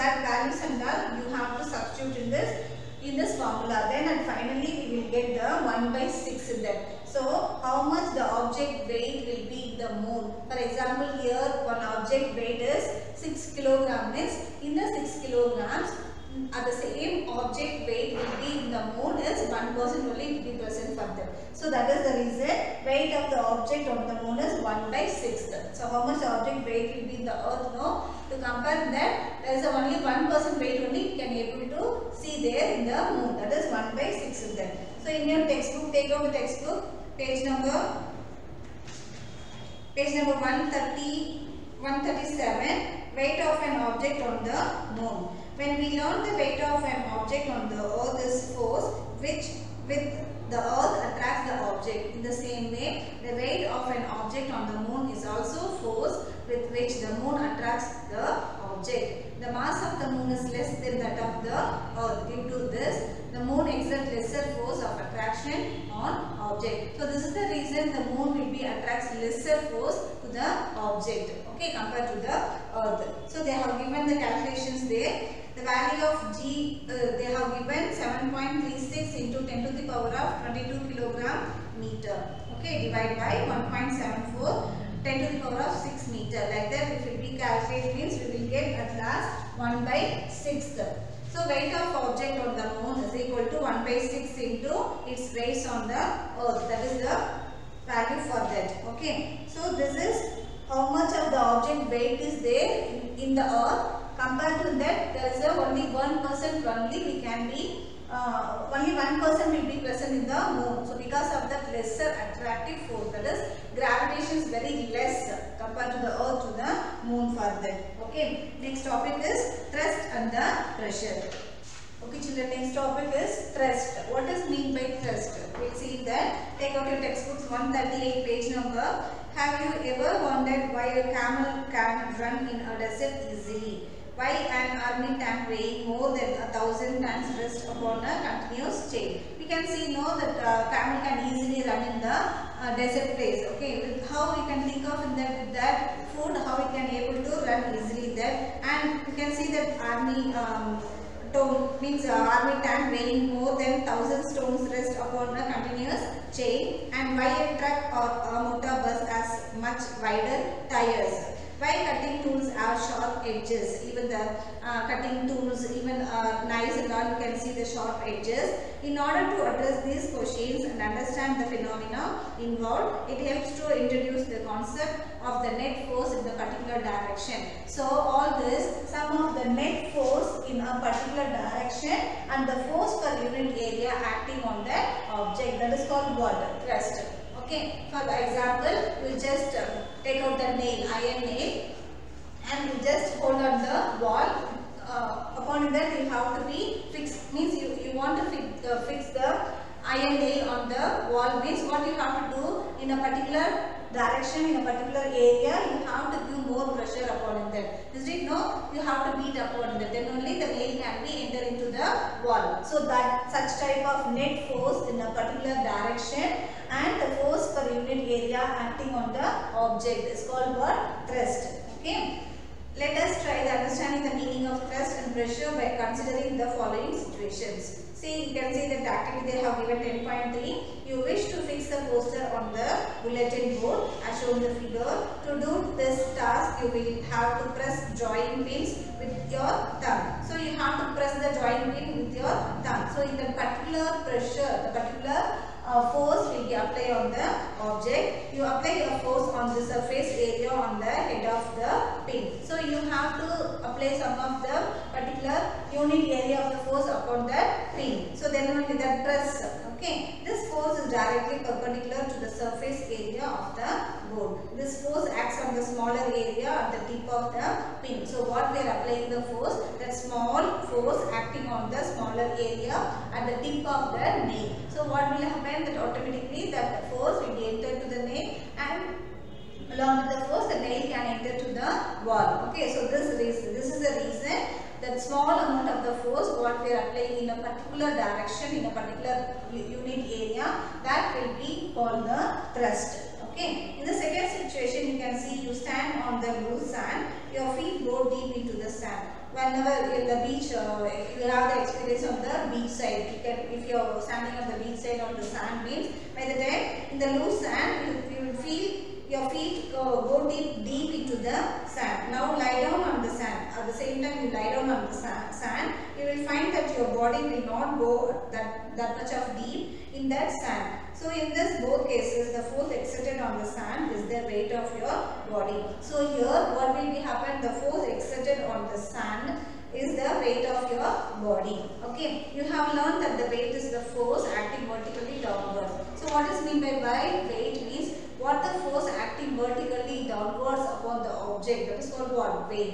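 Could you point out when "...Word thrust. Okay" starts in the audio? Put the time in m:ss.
3:40.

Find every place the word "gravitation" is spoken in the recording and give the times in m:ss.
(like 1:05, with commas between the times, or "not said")
1:53.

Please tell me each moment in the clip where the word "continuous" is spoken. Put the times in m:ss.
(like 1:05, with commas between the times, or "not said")
2:18, 2:35.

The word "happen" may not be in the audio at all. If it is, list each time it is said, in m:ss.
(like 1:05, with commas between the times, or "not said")
4:35, 5:26.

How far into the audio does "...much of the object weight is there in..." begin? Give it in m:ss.
1:40.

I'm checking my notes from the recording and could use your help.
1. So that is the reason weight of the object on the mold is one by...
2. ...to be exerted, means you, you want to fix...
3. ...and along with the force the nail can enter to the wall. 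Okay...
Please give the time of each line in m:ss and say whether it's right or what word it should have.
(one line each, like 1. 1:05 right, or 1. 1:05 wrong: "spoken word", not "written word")
1. 0:21 right
2. 3:16 wrong: "fixed", not "exerted"
3. 4:38 right.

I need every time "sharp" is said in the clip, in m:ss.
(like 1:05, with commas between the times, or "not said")
2:42, 2:47.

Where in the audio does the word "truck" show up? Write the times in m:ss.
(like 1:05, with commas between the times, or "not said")
2:37.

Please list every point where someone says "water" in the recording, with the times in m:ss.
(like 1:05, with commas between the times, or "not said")
3:06.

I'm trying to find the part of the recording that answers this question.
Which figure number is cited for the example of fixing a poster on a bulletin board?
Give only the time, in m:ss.
3:49.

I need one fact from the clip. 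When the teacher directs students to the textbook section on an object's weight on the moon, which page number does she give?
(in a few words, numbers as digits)
137.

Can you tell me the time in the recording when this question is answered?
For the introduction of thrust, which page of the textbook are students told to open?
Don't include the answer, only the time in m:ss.
2:07.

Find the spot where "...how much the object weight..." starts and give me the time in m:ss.
0:07.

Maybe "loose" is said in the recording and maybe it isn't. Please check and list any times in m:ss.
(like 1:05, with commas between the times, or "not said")
4:56, 5:07.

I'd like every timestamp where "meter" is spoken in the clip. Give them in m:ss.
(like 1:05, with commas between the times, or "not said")
1:21, 1:26.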